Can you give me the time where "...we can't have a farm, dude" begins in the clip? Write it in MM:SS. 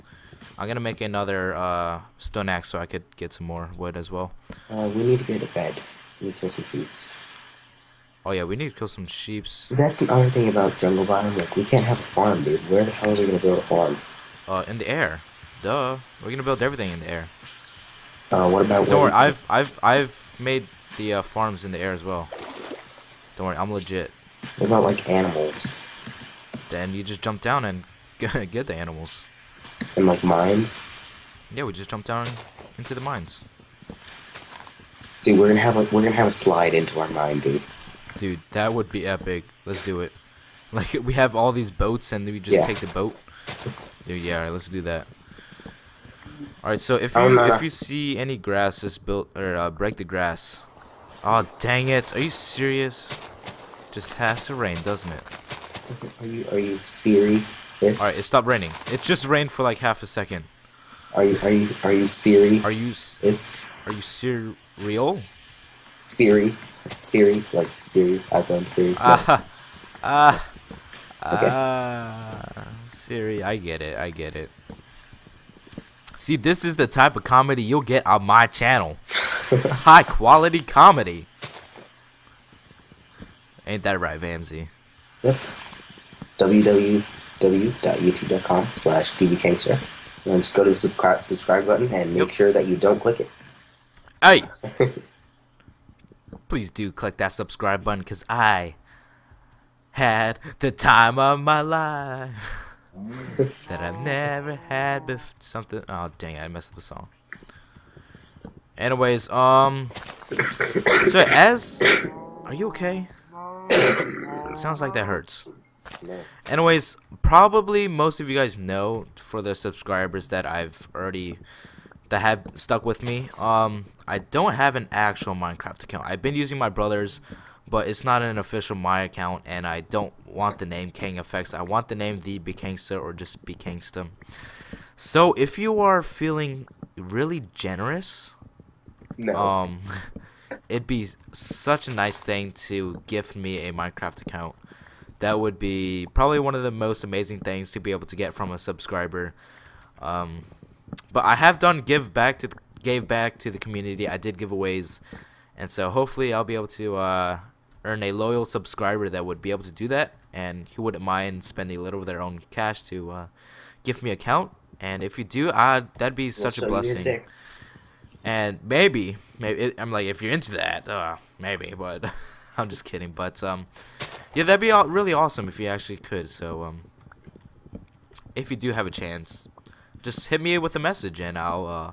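00:11.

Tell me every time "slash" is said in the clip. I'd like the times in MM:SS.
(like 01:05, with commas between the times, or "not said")
01:28.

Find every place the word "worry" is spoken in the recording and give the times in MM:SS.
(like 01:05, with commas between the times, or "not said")
00:19, 00:23.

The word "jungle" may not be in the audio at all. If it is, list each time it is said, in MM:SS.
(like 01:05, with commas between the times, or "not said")
00:10.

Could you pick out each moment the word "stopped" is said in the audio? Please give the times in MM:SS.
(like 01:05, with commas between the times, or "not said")
00:58.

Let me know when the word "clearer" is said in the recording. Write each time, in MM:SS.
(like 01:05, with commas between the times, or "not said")
not said.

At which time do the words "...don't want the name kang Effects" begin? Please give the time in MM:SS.
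02:09.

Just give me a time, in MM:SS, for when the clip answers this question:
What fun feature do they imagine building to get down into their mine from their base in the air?
00:36.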